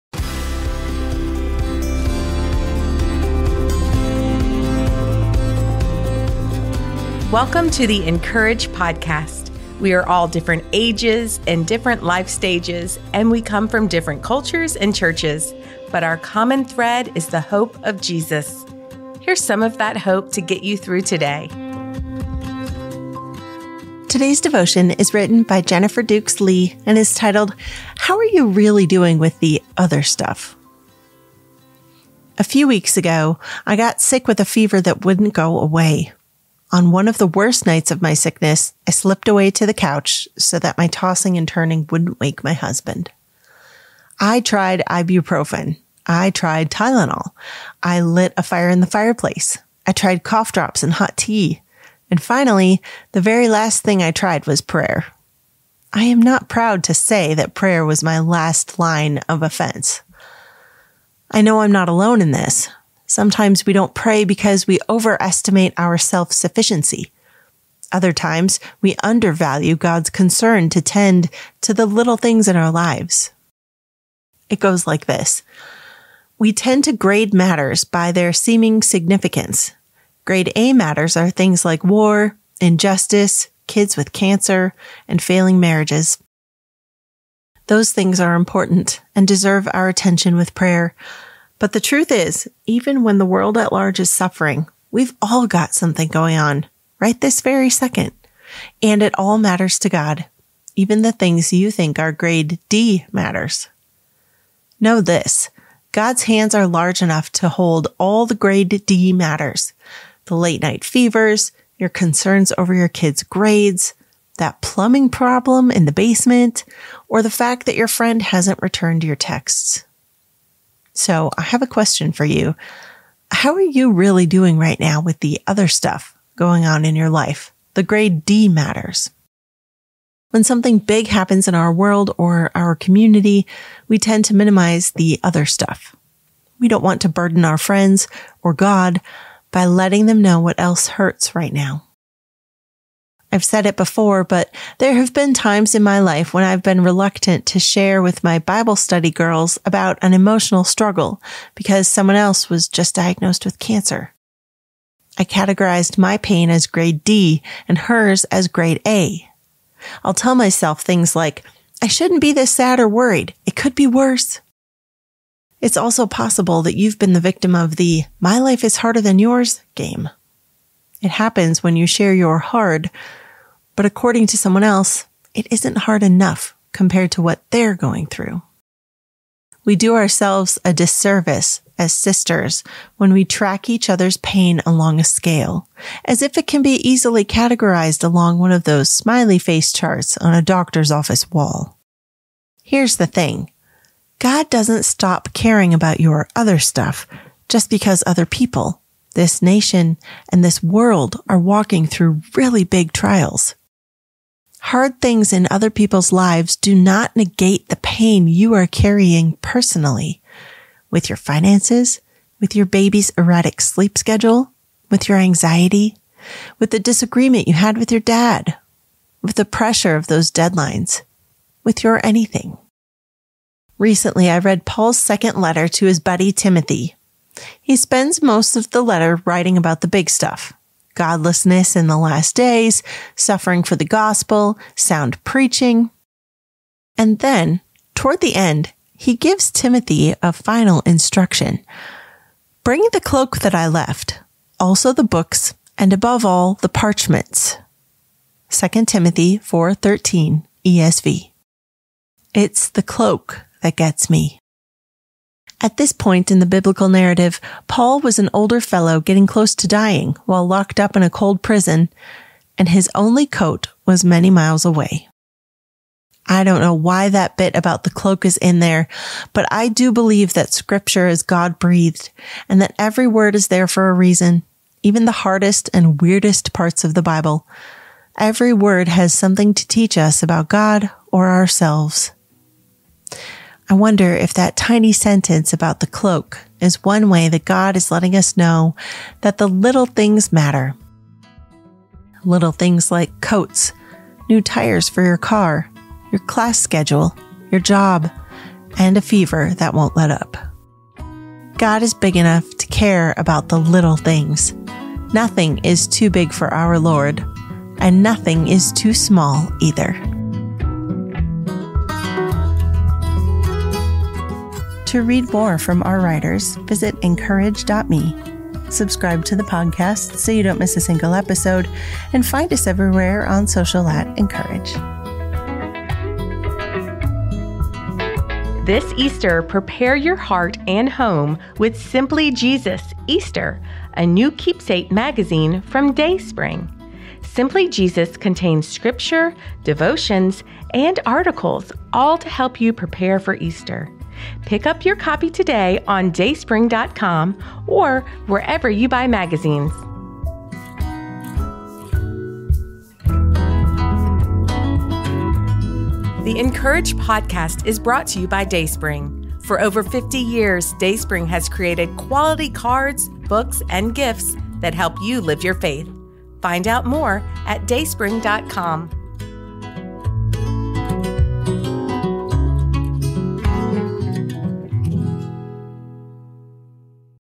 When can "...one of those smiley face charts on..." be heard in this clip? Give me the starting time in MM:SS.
03:08.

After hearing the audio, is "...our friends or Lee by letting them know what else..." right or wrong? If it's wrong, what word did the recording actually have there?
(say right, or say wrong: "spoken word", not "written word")
wrong: "God", not "Lee".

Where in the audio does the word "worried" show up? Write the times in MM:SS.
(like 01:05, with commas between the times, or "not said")
02:42.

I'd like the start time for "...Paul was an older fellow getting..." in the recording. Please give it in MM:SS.
04:17.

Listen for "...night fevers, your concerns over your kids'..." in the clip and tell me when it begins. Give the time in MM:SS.
01:50.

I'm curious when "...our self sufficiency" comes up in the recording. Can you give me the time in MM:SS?
01:05.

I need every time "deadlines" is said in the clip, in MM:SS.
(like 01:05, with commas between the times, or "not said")
03:40.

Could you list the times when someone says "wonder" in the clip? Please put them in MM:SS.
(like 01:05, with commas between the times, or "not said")
04:43.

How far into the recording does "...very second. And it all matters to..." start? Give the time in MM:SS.
01:37.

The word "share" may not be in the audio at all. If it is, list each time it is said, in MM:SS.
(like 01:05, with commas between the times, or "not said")
02:27, 02:51.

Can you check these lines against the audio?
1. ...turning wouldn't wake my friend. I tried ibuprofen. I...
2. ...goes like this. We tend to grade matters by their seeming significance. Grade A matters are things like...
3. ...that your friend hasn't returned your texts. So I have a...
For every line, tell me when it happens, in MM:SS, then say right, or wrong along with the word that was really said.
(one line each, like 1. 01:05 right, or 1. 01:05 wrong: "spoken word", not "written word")
1. 00:41 wrong: "husband", not "friend"
2. 01:14 right
3. 01:57 right.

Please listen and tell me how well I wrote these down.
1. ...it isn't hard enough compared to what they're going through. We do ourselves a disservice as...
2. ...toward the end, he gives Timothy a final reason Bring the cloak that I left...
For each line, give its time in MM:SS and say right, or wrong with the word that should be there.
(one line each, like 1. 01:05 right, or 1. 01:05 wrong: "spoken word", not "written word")
1. 02:55 right
2. 03:57 wrong: "instruction", not "reason".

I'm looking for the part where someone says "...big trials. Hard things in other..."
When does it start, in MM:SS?
03:22.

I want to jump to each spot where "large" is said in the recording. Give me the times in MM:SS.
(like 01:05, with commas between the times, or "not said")
01:33, 01:46.